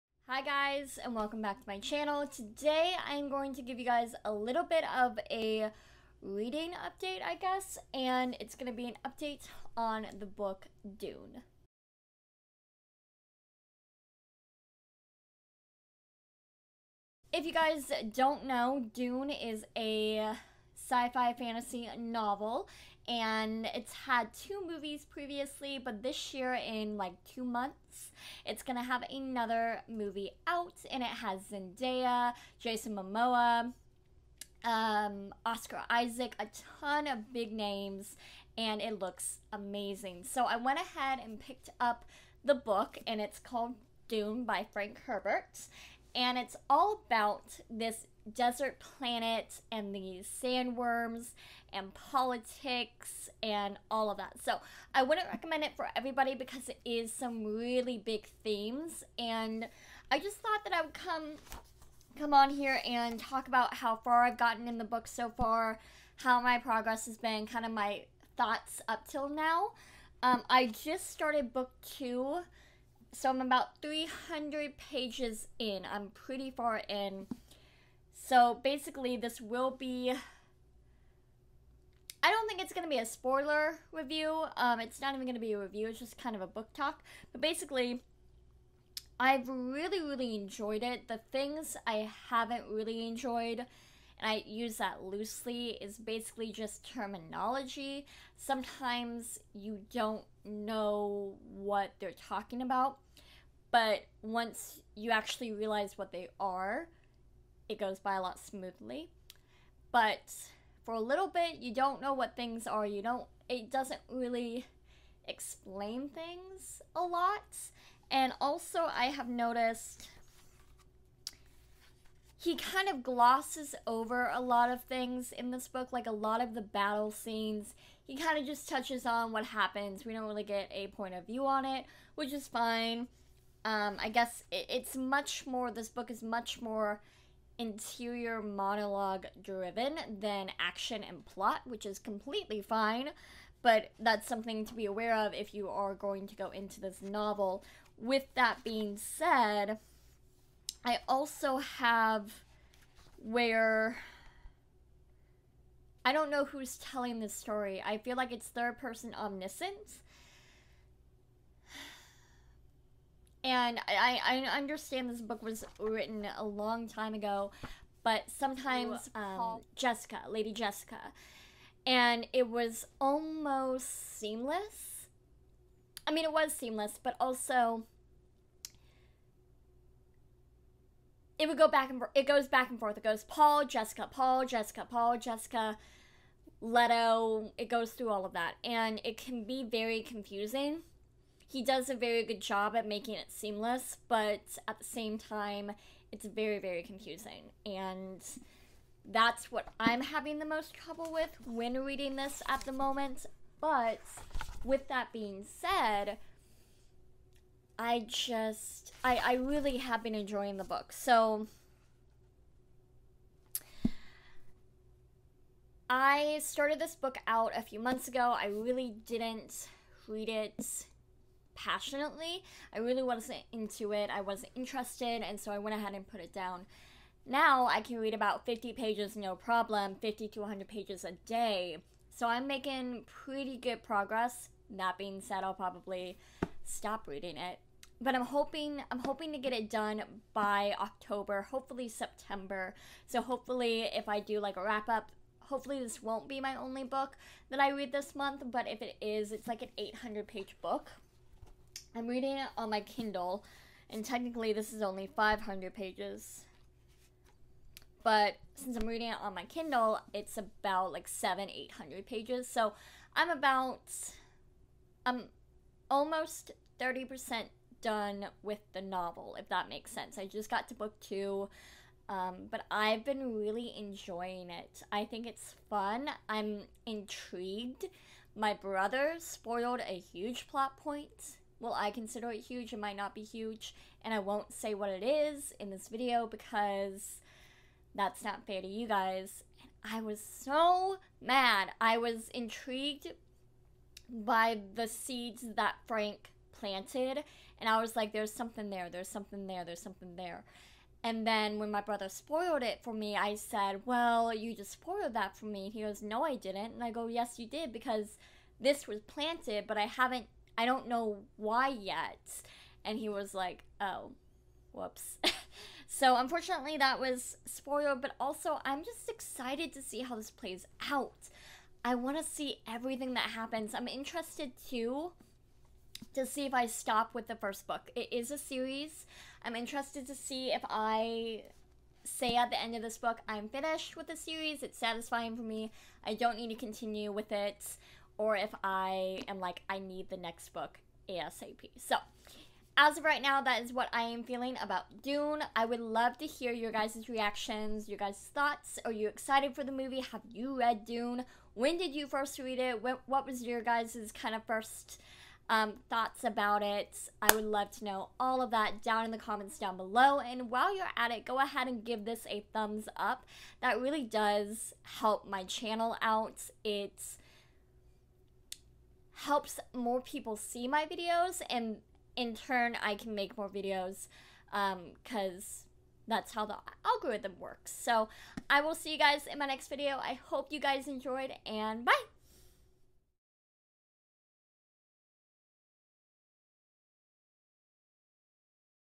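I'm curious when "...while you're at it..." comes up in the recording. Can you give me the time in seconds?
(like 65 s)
360 s.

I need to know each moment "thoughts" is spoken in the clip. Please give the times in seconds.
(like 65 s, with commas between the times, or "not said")
60 s, 68 s, 348 s, 355 s.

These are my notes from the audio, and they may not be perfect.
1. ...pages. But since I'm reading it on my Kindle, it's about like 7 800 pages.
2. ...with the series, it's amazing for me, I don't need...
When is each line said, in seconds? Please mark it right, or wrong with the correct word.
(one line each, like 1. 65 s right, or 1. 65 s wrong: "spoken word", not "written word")
1. 255 s right
2. 333 s wrong: "satisfying", not "amazing".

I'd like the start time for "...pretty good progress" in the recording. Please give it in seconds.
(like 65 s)
233 s.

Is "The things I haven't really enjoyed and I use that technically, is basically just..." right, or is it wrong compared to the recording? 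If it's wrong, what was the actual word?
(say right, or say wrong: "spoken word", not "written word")
wrong: "loosely", not "technically".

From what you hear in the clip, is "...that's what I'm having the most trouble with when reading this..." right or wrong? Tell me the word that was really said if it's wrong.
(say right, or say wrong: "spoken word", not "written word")
right.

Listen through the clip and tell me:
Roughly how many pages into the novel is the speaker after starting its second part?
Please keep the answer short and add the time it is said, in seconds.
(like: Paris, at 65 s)
300, at 73 s.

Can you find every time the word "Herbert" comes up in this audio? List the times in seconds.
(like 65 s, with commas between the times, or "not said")
45 s.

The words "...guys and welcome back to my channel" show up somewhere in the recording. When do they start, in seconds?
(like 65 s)
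0 s.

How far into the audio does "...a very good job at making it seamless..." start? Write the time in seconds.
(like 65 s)
191 s.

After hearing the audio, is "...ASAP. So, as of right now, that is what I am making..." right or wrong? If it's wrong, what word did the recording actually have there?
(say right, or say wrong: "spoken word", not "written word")
wrong: "feeling", not "making".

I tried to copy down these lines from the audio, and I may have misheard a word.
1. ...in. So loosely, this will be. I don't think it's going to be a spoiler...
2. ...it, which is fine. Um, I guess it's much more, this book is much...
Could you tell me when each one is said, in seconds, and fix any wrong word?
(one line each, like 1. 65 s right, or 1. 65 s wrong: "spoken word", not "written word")
1. 76 s wrong: "basically", not "loosely"
2. 131 s right.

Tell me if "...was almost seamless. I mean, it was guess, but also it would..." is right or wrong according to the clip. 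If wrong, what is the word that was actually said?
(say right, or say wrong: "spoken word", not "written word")
wrong: "seamless", not "guess".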